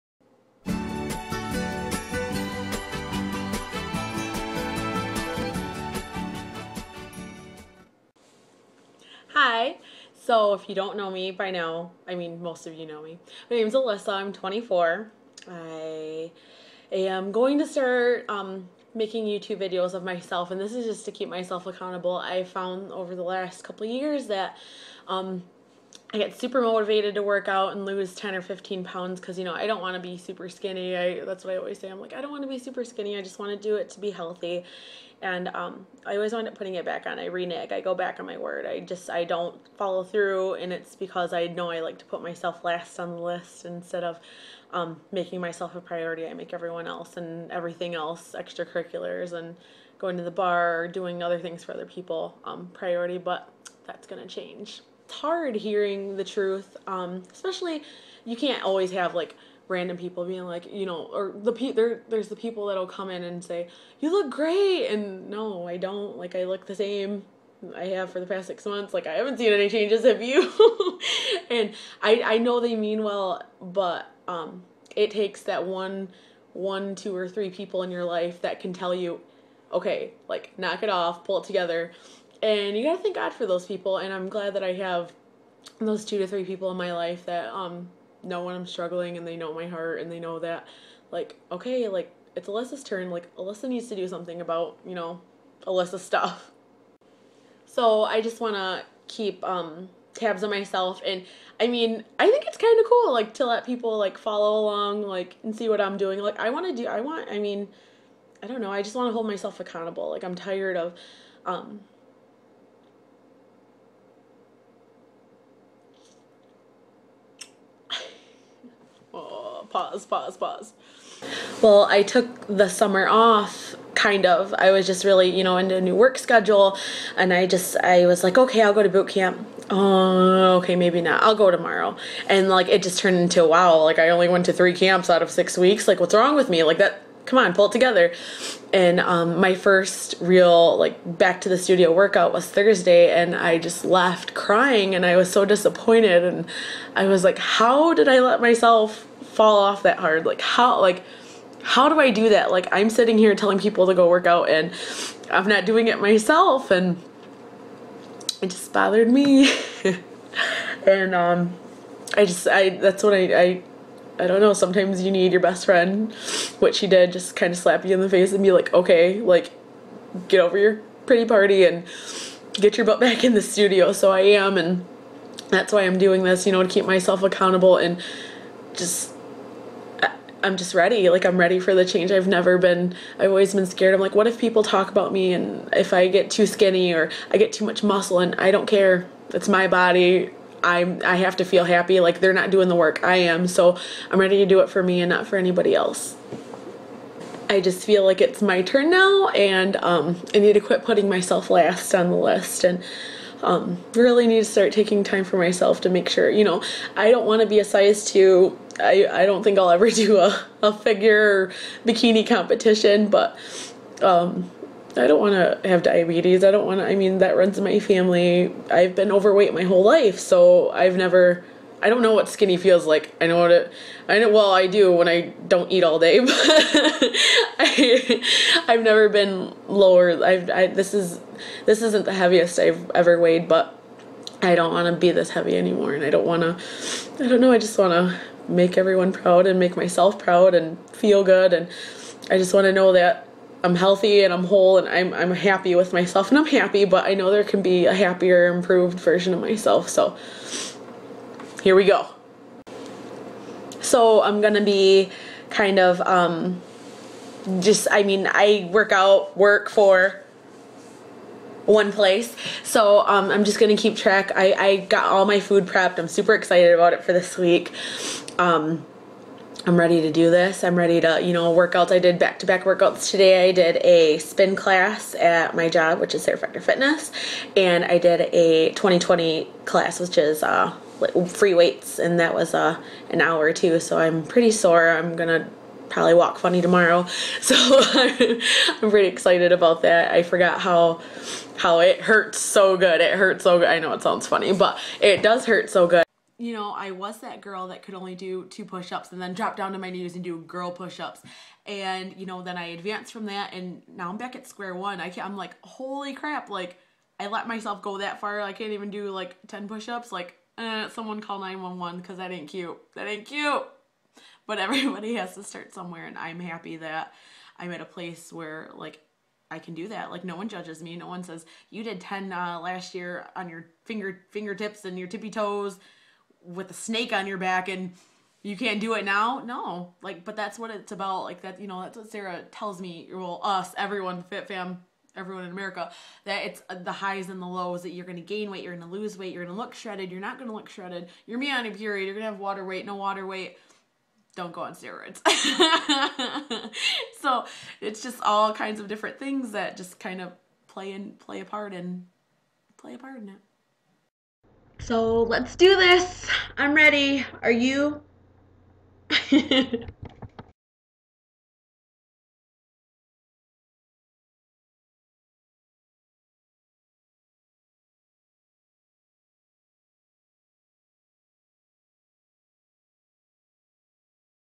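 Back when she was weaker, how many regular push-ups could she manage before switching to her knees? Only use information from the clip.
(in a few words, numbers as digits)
2.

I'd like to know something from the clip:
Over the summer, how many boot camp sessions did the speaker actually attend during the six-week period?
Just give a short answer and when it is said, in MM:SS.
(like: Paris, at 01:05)
3, at 02:14.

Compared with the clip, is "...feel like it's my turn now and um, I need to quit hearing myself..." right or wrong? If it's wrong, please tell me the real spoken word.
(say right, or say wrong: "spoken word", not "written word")
wrong: "putting", not "hearing".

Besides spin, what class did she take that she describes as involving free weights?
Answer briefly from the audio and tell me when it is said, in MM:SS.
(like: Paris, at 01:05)
2020, at 04:38.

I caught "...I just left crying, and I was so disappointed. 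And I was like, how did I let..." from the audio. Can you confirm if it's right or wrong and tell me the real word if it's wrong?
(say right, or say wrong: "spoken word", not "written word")
right.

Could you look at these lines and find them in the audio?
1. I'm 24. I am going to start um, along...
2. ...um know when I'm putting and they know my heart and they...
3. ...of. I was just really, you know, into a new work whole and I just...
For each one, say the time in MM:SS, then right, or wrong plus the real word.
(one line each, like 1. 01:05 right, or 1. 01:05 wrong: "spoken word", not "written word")
1. 00:14 wrong: "making", not "along"
2. 01:27 wrong: "struggling", not "putting"
3. 02:04 wrong: "schedule", not "whole".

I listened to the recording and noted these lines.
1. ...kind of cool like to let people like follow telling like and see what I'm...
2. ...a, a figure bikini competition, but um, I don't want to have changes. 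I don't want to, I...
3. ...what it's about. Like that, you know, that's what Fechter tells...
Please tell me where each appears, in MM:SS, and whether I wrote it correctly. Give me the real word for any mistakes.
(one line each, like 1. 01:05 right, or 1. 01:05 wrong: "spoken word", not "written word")
1. 01:42 wrong: "along", not "telling"
2. 03:30 wrong: "diabetes", not "changes"
3. 05:30 wrong: "Sarah", not "Fechter".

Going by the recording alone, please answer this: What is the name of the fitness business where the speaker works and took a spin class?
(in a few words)
Sarah Fechter Fitness.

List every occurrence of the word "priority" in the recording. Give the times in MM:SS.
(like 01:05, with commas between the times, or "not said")
00:45, 00:52.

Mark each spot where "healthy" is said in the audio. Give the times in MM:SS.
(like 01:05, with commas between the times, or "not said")
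00:34, 04:03.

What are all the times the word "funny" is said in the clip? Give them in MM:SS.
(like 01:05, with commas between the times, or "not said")
04:46, 04:54.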